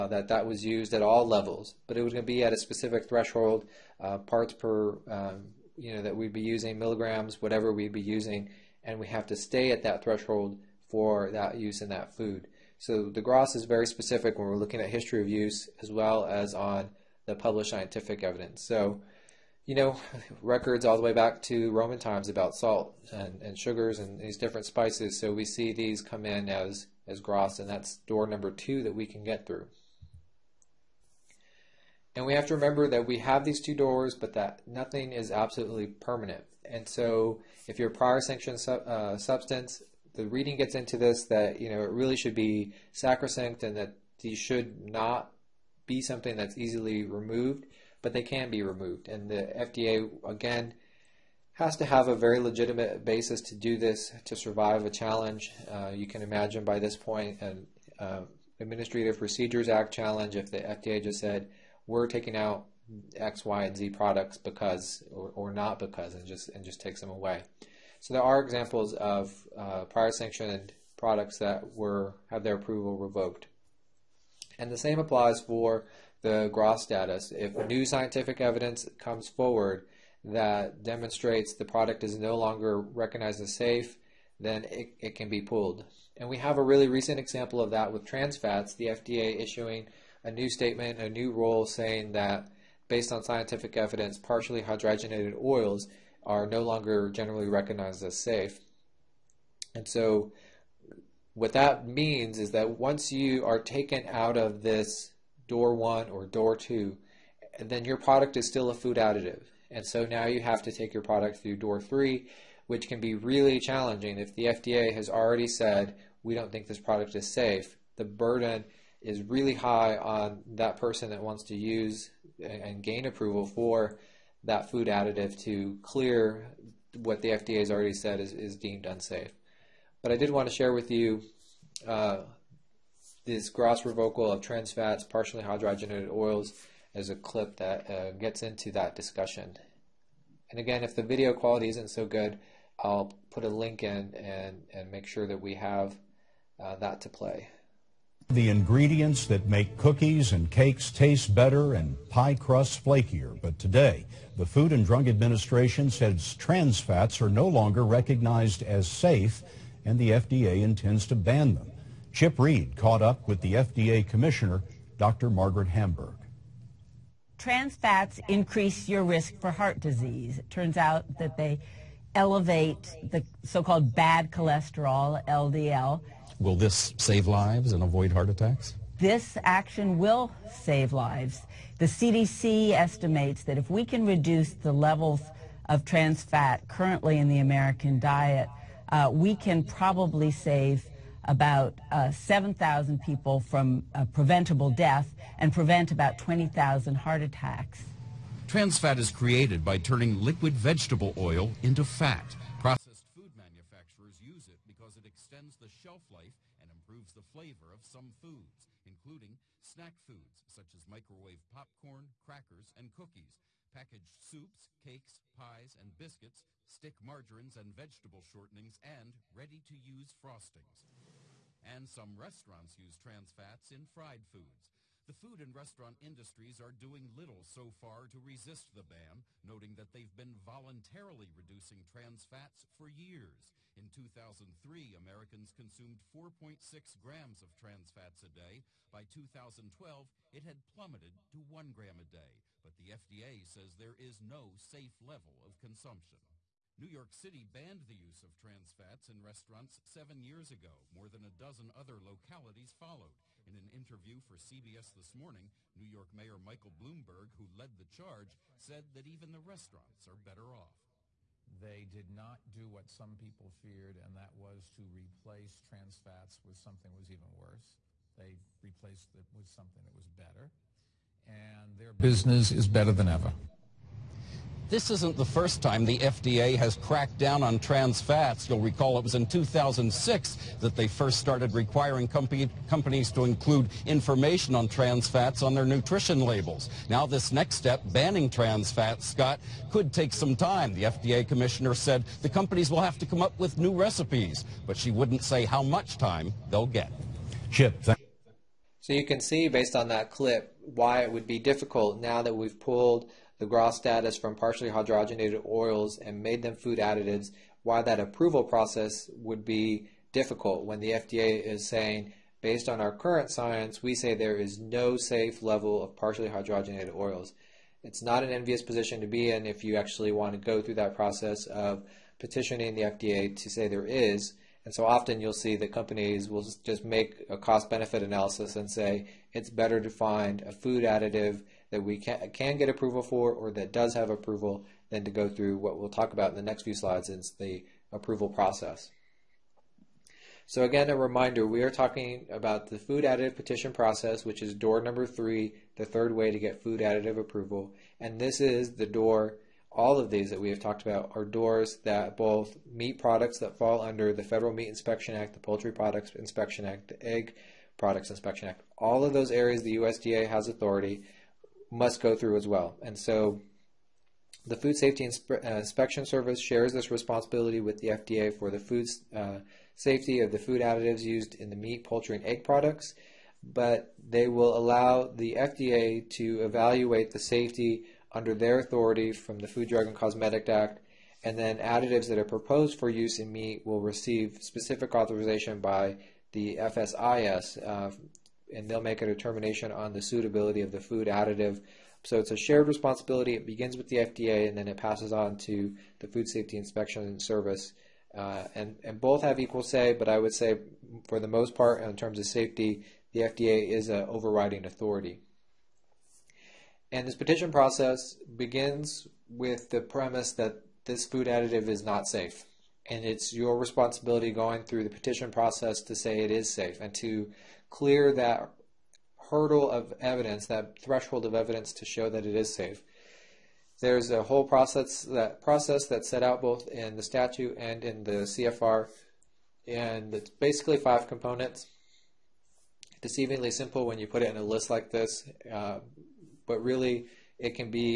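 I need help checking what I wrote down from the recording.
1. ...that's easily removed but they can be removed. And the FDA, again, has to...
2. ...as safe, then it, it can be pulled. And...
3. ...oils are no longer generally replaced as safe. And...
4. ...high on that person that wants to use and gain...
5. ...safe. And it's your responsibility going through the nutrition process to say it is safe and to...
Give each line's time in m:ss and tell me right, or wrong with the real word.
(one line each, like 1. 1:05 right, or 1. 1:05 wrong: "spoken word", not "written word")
1. 0:46 right
2. 1:23 right
3. 1:35 wrong: "recognized", not "replaced"
4. 1:59 right
5. 6:52 wrong: "petition", not "nutrition".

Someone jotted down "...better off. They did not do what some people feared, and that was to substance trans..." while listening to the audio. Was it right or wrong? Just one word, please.
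wrong.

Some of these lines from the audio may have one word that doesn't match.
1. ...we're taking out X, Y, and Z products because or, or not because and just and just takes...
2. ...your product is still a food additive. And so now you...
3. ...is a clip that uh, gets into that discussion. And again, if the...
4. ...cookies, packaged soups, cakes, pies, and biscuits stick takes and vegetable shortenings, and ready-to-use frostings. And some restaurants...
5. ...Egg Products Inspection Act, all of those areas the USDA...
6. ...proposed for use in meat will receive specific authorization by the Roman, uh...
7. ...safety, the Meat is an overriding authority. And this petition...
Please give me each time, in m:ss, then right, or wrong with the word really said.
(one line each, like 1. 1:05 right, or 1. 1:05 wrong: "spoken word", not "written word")
1. 1:01 right
2. 1:47 right
3. 2:16 right
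4. 3:32 wrong: "margarines", not "takes"
5. 5:57 right
6. 6:22 wrong: "FSIS", not "Roman"
7. 6:42 wrong: "FDA", not "Meat".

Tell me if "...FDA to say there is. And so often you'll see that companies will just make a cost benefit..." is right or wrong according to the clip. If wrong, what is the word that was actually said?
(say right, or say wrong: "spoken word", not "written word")
right.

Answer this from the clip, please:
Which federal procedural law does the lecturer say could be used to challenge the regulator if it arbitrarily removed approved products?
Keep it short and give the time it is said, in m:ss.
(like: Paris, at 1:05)
Administrative Procedures Act, at 0:58.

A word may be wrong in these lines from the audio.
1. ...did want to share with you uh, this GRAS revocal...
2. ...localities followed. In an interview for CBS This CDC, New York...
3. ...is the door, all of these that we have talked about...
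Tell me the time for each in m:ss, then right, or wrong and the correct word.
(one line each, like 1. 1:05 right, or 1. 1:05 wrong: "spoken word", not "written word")
1. 2:10 right
2. 4:12 wrong: "Morning", not "CDC"
3. 5:48 right.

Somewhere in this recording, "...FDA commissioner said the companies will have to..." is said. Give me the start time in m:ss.
4:50.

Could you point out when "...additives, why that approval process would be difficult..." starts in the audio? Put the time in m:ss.
5:06.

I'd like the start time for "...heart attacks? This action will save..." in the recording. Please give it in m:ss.
2:58.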